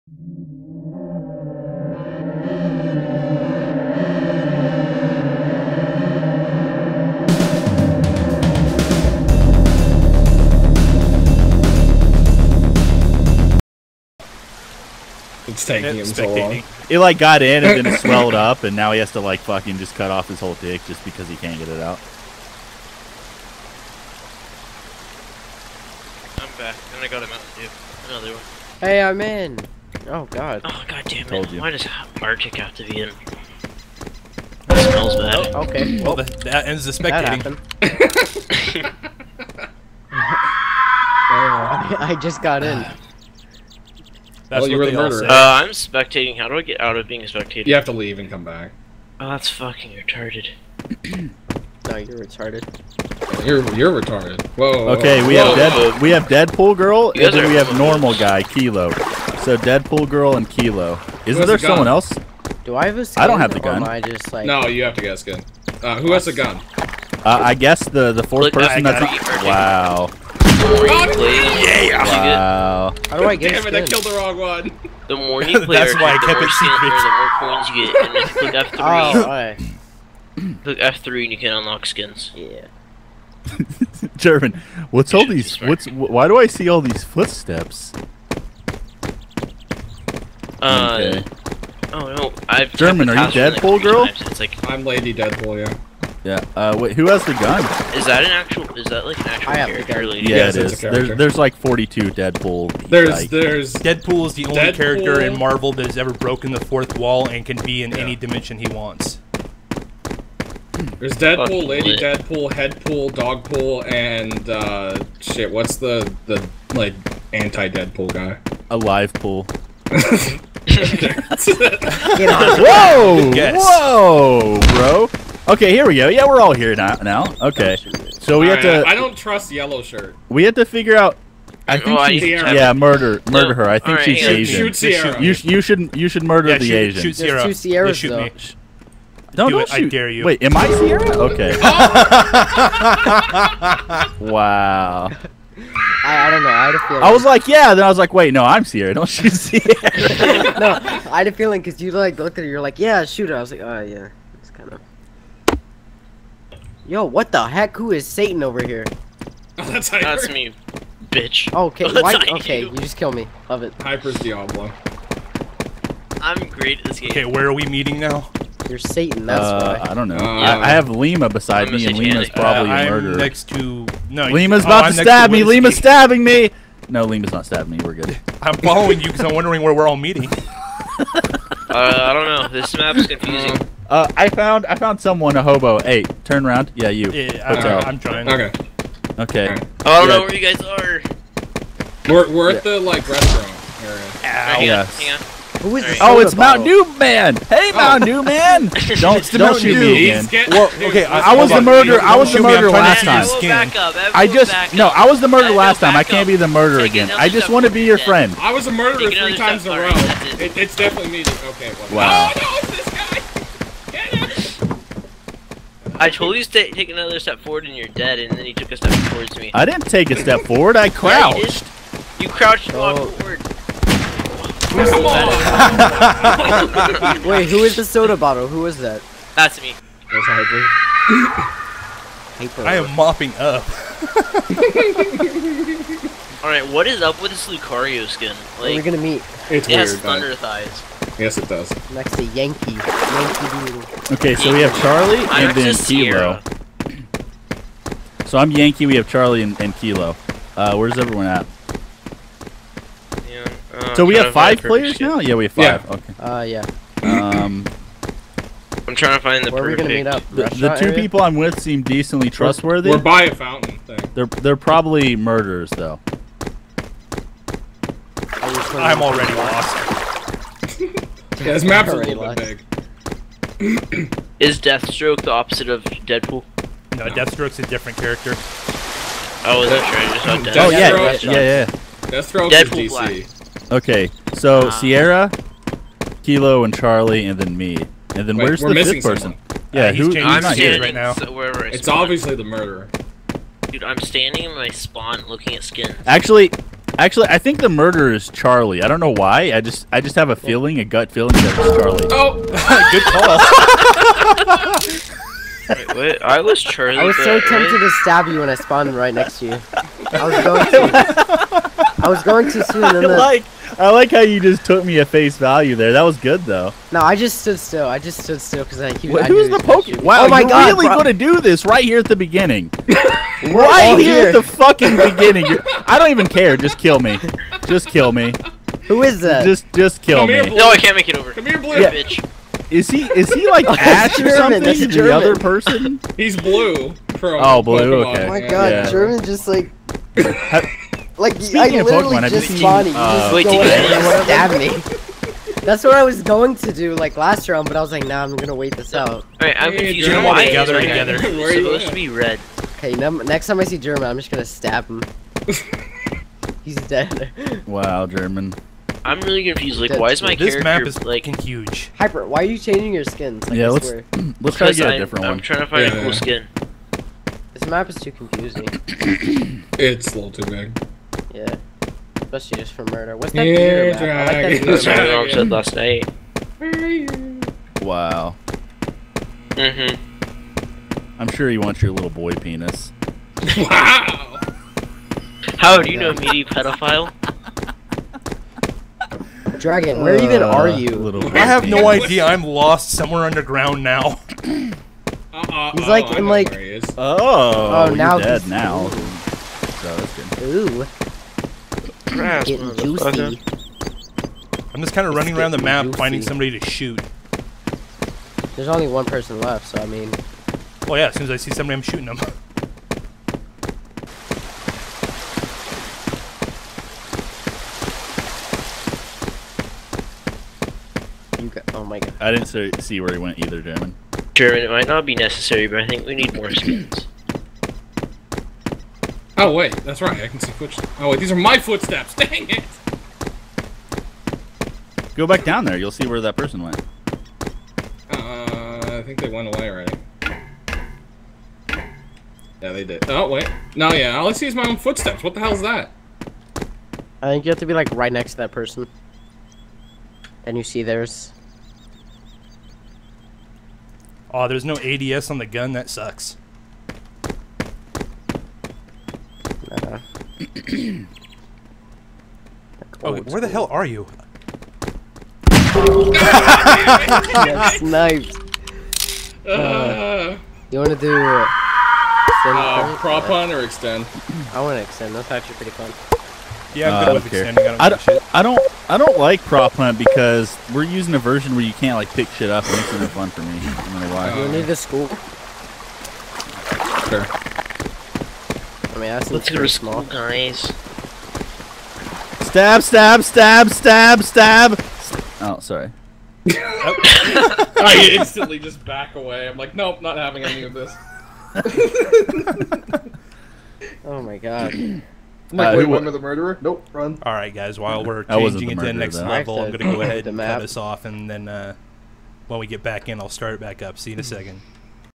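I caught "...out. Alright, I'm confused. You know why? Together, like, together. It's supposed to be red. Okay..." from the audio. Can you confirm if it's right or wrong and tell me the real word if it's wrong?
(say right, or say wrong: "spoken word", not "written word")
right.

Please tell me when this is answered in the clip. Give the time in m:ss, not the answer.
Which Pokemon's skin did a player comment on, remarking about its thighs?
3:57.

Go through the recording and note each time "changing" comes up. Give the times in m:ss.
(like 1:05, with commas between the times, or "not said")
6:02, 8:28.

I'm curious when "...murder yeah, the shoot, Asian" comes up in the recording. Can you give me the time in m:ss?
2:16.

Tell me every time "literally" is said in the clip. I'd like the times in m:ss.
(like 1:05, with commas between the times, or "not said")
5:41.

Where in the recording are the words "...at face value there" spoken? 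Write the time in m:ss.
5:14.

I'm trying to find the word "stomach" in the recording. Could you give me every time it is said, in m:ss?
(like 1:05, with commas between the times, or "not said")
not said.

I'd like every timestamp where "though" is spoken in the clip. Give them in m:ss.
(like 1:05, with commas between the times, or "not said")
2:18, 4:25, 5:16.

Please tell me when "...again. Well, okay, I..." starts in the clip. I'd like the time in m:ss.
3:20.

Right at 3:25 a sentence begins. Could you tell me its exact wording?
I can't be the murderer again.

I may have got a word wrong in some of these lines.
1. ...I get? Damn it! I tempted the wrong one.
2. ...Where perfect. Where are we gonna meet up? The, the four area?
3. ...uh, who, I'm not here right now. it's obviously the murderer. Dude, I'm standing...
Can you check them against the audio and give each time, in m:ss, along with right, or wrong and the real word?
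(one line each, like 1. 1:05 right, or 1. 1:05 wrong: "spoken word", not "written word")
1. 1:13 wrong: "killed", not "tempted"
2. 4:19 wrong: "two", not "four"
3. 4:49 right.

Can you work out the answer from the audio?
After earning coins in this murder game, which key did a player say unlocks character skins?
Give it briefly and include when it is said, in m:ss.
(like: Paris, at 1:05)
F3, at 1:20.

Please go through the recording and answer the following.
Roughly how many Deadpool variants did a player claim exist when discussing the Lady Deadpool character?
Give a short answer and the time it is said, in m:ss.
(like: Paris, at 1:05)
42, at 1:41.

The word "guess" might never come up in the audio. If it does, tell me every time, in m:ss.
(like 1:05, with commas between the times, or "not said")
1:07, 2:03.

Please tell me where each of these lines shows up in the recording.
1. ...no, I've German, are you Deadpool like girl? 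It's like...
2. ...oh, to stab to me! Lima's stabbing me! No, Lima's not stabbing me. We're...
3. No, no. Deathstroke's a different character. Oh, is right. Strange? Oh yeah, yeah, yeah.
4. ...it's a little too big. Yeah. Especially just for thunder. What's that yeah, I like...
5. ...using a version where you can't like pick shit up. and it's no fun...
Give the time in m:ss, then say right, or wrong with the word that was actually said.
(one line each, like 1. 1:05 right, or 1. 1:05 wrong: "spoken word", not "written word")
1. 1:32 right
2. 2:54 right
3. 4:36 right
4. 6:09 wrong: "murder", not "thunder"
5. 8:00 right.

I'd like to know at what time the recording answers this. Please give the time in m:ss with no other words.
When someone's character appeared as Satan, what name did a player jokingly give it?
2:43.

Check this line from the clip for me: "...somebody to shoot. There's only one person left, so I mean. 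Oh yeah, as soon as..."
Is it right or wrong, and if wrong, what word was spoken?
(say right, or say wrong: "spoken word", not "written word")
right.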